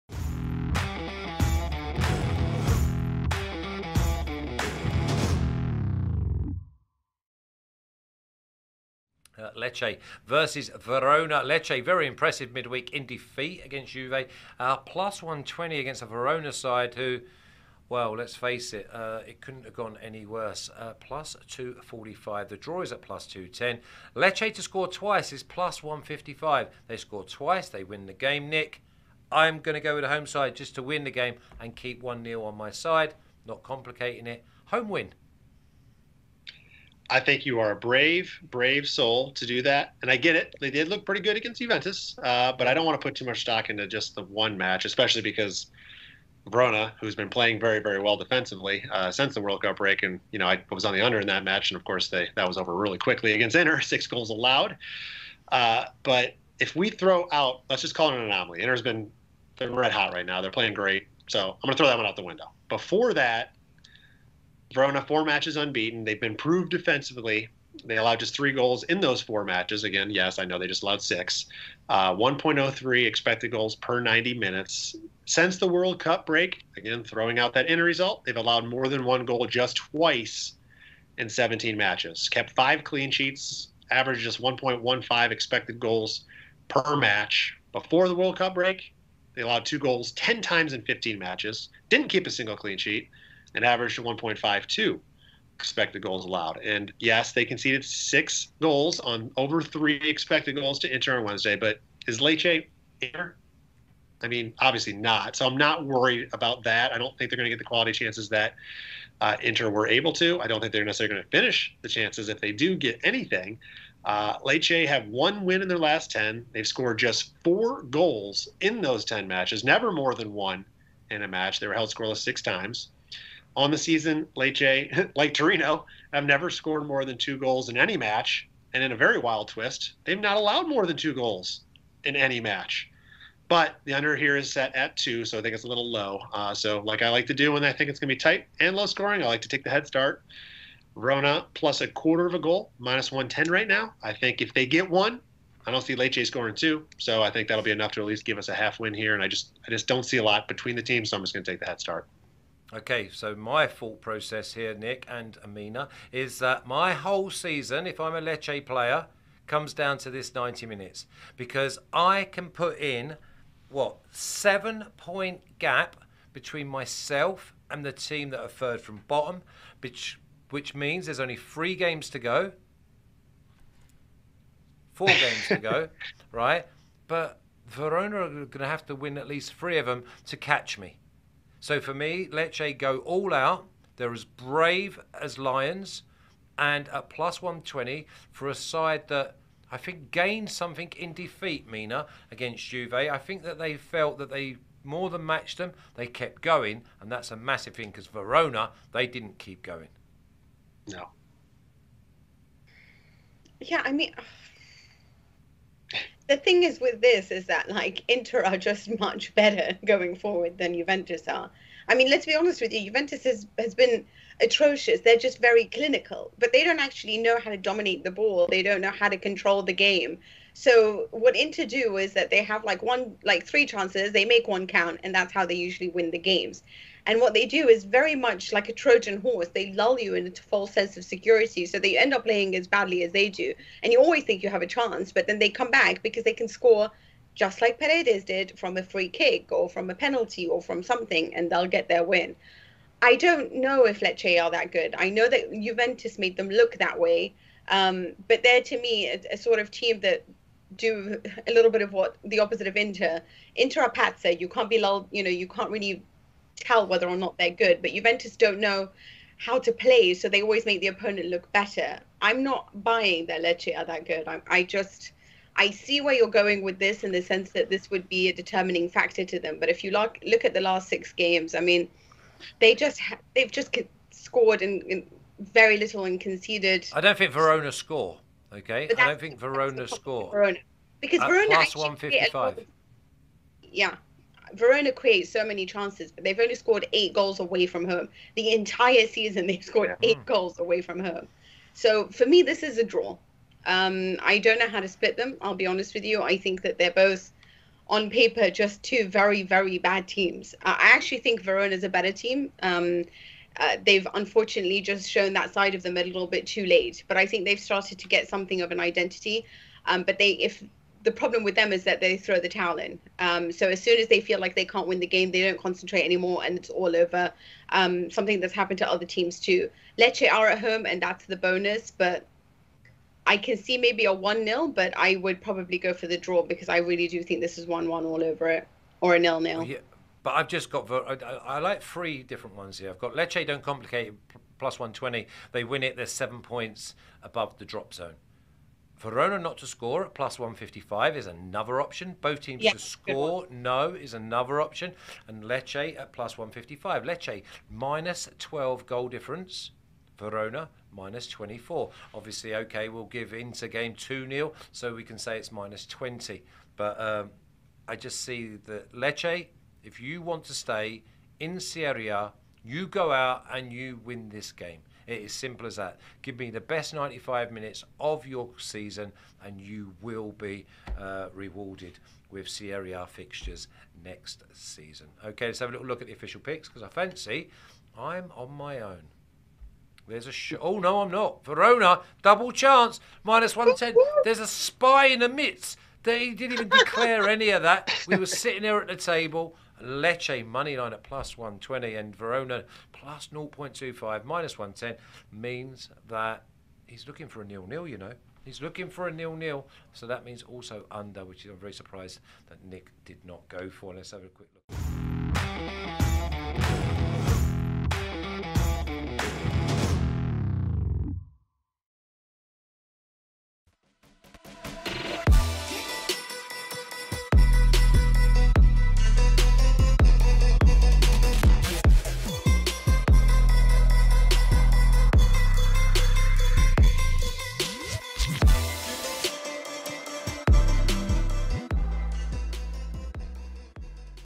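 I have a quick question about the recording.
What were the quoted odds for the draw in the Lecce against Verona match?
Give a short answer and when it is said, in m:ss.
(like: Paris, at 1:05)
+210, at 0:23.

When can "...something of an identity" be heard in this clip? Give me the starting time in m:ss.
5:08.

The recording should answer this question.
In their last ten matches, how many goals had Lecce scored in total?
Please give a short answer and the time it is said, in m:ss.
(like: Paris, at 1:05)
4, at 1:57.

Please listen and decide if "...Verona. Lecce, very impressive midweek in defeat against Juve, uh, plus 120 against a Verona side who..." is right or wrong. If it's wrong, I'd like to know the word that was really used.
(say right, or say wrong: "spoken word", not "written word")
right.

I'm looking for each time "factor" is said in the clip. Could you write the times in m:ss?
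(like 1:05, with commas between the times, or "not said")
4:28.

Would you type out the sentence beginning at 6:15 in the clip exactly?
Okay, let's have a little look at the official picks because I fancy I'm on my own.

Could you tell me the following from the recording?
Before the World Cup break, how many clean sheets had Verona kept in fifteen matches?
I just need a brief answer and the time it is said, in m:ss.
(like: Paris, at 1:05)
0, at 1:31.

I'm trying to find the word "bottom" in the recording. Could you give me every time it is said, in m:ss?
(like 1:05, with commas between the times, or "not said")
2:49.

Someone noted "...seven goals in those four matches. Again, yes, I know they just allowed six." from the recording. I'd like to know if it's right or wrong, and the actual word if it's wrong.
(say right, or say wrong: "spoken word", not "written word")
wrong: "three", not "seven".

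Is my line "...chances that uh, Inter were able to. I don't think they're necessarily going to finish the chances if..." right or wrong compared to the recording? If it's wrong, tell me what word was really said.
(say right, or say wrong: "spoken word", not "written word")
right.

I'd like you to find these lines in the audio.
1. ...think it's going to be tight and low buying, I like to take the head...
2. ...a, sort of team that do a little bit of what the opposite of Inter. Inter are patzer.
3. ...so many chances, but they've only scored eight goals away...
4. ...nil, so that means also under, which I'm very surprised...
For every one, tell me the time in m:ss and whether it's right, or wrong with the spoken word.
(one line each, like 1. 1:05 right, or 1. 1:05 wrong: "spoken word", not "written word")
1. 2:17 wrong: "scoring", not "buying"
2. 4:09 right
3. 4:45 right
4. 6:39 right.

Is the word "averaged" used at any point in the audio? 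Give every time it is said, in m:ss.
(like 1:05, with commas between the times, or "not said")
1:23, 1:33.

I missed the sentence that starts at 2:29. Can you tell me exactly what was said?
And I just I just don't see a lot between the teams, so I'm just going to take the head start.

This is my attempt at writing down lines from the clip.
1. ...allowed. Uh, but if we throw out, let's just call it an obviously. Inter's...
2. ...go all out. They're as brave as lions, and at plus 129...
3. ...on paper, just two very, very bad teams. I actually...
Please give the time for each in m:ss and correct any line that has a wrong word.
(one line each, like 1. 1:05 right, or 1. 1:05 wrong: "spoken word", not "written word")
1. 0:54 wrong: "anomaly", not "obviously"
2. 3:02 wrong: "120", not "129"
3. 4:57 right.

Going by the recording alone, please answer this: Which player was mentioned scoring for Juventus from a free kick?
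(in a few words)
Paredes.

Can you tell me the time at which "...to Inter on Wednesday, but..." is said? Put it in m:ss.
1:40.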